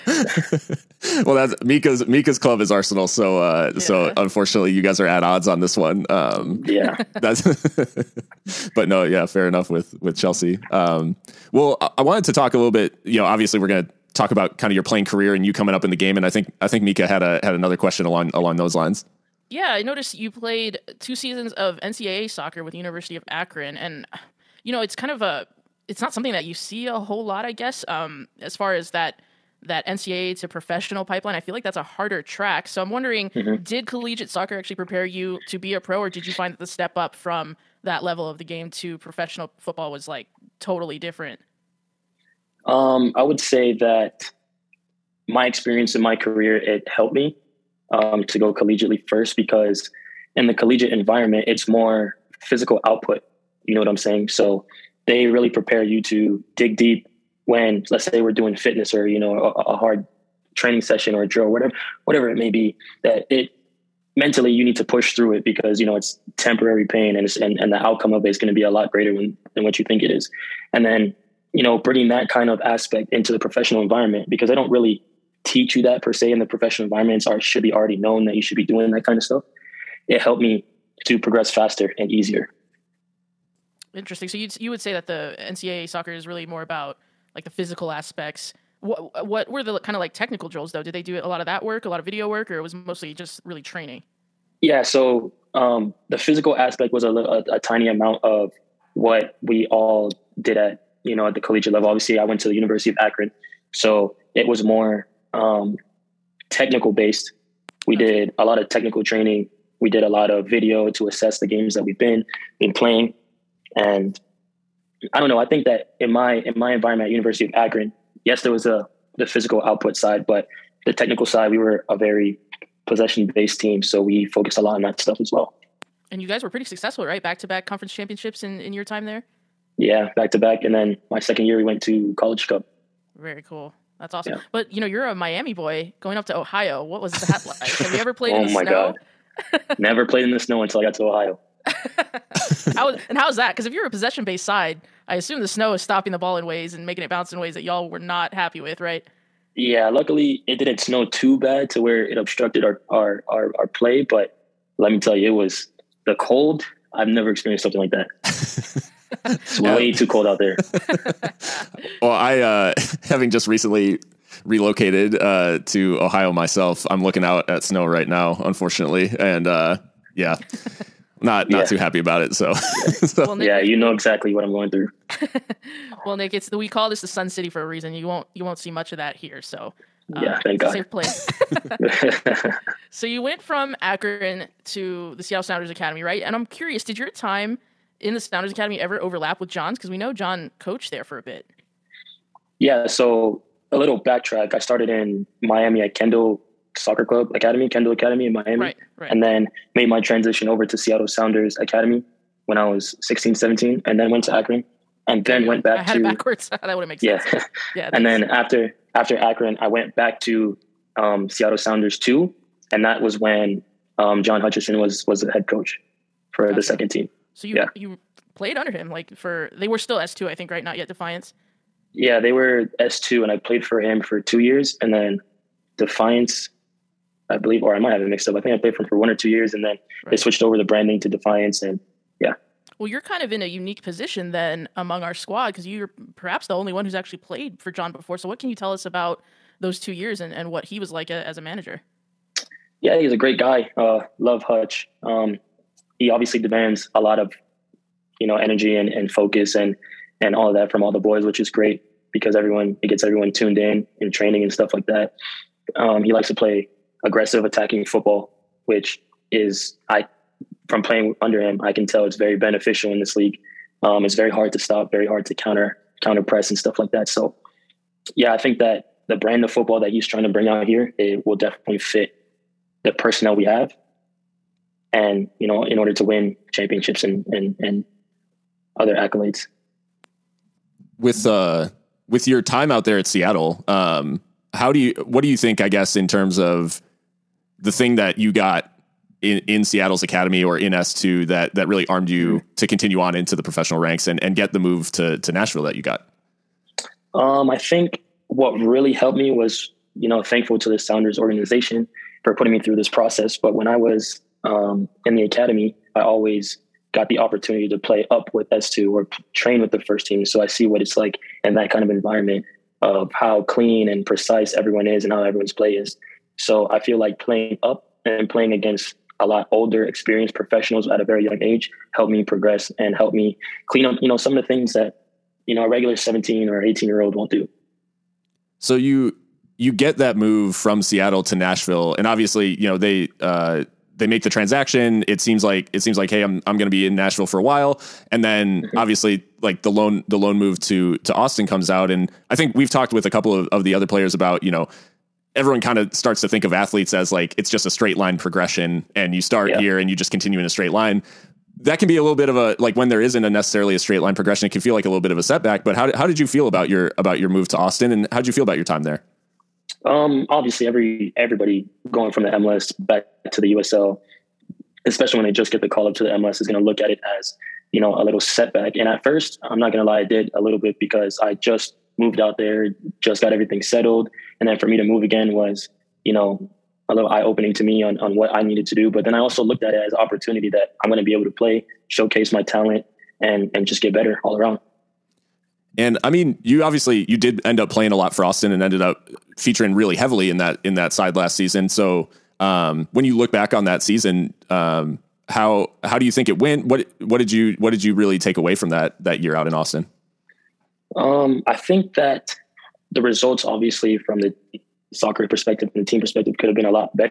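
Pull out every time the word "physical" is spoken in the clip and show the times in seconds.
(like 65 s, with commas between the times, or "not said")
52 s, 87 s, 96 s, 119 s.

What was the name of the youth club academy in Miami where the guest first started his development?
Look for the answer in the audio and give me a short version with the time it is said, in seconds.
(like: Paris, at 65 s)
Kendall Soccer Club Academy, at 195 s.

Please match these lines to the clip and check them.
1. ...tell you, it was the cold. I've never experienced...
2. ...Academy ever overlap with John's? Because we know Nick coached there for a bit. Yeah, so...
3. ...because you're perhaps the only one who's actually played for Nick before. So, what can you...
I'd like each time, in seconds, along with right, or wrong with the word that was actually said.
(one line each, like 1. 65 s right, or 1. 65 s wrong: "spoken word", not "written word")
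1. 155 s right
2. 188 s wrong: "John", not "Nick"
3. 235 s wrong: "John", not "Nick".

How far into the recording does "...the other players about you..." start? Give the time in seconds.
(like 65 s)
343 s.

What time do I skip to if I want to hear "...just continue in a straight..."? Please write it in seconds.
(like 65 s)
349 s.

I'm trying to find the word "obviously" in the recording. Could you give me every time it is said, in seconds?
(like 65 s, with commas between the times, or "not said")
13 s, 101 s, 246 s, 332 s, 338 s, 360 s, 386 s, 403 s.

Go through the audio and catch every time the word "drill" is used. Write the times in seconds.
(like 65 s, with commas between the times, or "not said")
61 s, 90 s.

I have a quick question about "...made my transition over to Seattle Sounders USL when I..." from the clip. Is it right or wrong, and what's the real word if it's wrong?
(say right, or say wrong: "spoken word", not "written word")
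wrong: "Academy", not "USL".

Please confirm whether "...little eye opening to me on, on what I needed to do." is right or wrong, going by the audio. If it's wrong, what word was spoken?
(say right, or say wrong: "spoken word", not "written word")
right.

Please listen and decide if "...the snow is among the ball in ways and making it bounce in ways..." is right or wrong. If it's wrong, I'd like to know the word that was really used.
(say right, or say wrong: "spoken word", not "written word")
wrong: "stopping", not "among".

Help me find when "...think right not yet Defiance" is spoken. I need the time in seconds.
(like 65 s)
220 s.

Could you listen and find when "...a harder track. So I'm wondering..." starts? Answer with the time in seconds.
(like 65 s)
31 s.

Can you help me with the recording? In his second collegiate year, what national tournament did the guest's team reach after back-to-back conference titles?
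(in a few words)
College Cup.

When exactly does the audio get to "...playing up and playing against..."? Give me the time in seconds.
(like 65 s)
317 s.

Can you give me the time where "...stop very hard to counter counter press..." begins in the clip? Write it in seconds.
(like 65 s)
264 s.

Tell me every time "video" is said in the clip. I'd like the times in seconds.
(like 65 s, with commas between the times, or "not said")
92 s, 110 s.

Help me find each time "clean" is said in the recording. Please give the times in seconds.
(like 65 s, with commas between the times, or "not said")
313 s, 323 s.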